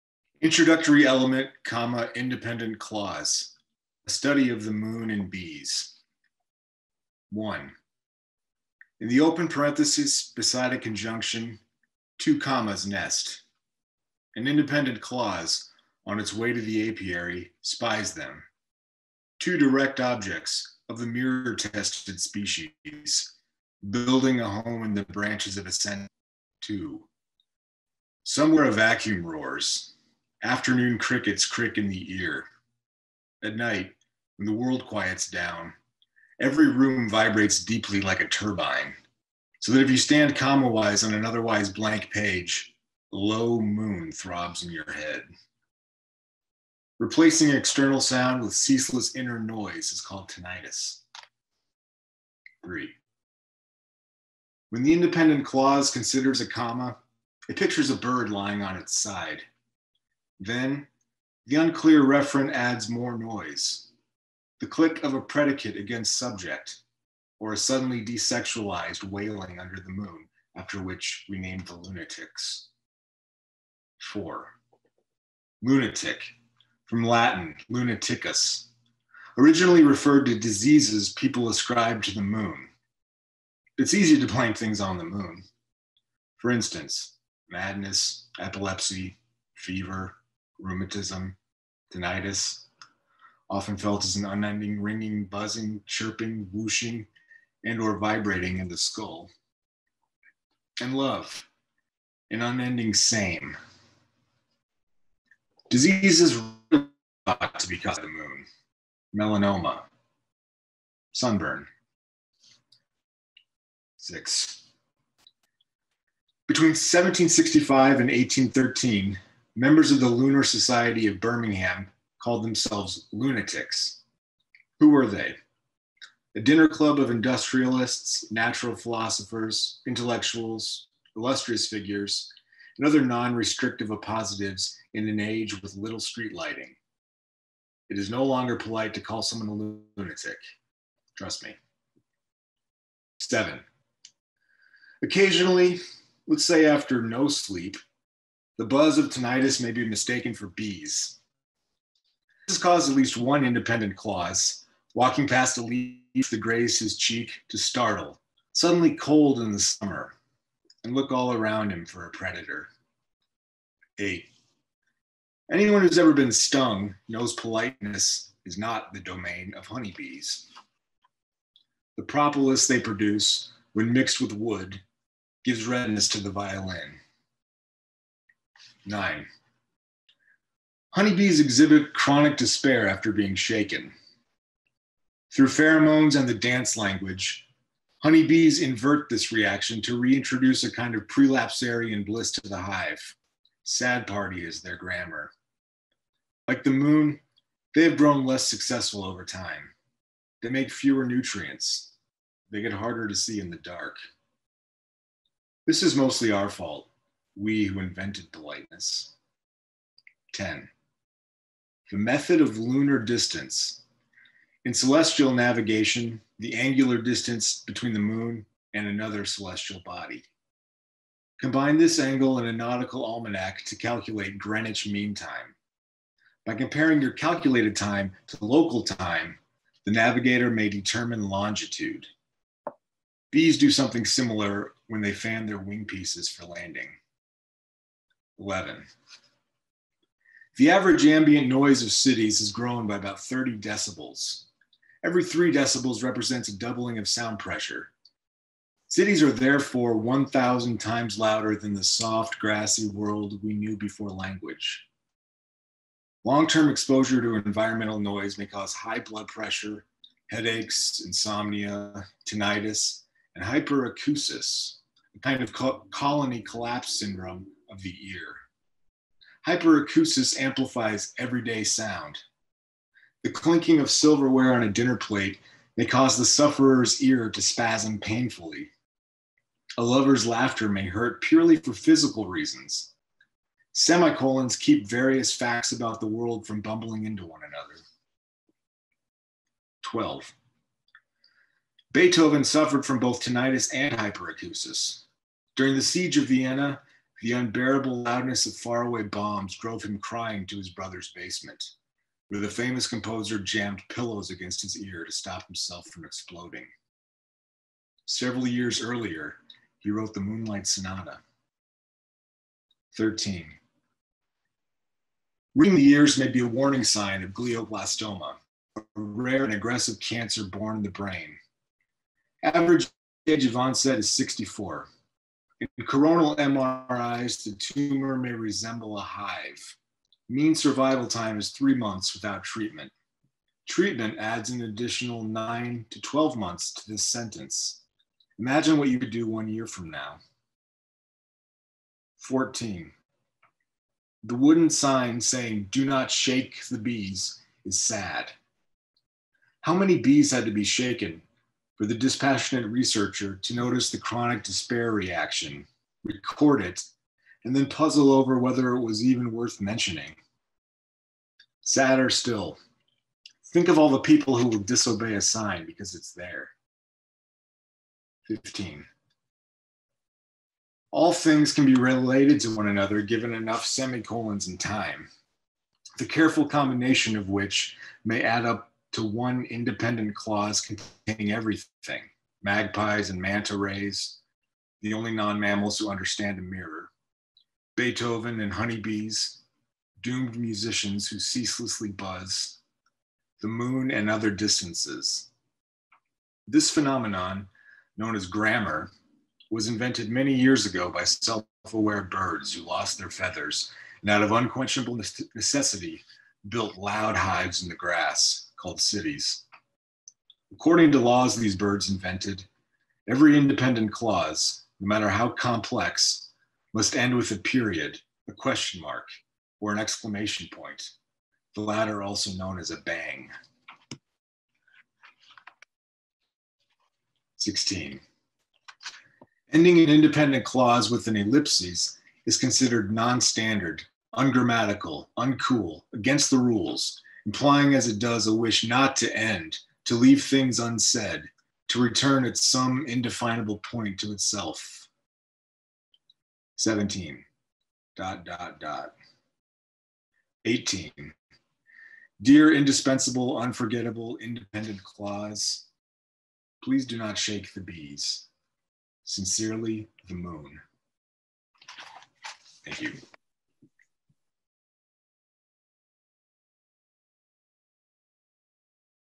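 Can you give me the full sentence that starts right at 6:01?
Sadder still, think of all the people who will disobey a sign because it's there.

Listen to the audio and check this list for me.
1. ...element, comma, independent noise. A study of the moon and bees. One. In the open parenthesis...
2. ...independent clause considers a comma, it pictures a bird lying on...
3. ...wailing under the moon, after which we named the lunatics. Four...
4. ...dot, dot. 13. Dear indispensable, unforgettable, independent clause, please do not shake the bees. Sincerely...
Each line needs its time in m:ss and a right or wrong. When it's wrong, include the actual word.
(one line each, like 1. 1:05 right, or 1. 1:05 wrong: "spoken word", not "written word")
1. 0:01 wrong: "clause", not "noise"
2. 0:54 right
3. 1:09 right
4. 7:28 wrong: "18", not "13".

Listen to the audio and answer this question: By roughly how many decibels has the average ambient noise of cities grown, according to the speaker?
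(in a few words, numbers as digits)
30.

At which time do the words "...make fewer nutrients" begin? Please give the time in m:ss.
3:20.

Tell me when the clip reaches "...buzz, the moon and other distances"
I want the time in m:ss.
6:31.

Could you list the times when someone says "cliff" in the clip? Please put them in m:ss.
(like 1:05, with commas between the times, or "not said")
not said.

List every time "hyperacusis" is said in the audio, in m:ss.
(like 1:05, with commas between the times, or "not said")
4:23, 4:29, 4:53.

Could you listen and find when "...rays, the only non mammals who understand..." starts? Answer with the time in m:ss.
6:23.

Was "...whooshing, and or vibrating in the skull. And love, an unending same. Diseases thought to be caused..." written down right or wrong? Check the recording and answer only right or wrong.
right.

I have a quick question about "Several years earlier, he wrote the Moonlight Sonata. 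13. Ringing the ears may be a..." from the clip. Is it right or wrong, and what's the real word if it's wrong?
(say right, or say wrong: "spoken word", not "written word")
right.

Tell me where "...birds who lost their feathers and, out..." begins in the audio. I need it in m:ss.
6:42.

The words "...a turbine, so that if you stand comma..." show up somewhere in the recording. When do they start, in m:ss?
0:38.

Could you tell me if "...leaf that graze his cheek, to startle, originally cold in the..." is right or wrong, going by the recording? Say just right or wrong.
wrong.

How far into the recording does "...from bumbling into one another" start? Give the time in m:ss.
4:46.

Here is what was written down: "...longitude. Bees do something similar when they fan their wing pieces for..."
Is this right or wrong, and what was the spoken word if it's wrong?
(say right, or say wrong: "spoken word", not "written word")
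right.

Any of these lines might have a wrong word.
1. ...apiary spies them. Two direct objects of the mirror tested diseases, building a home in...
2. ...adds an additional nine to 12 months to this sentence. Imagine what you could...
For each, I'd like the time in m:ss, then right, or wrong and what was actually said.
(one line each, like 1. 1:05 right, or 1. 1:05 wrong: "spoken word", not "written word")
1. 0:16 wrong: "species", not "diseases"
2. 5:34 right.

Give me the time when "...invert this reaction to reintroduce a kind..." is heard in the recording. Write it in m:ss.
3:08.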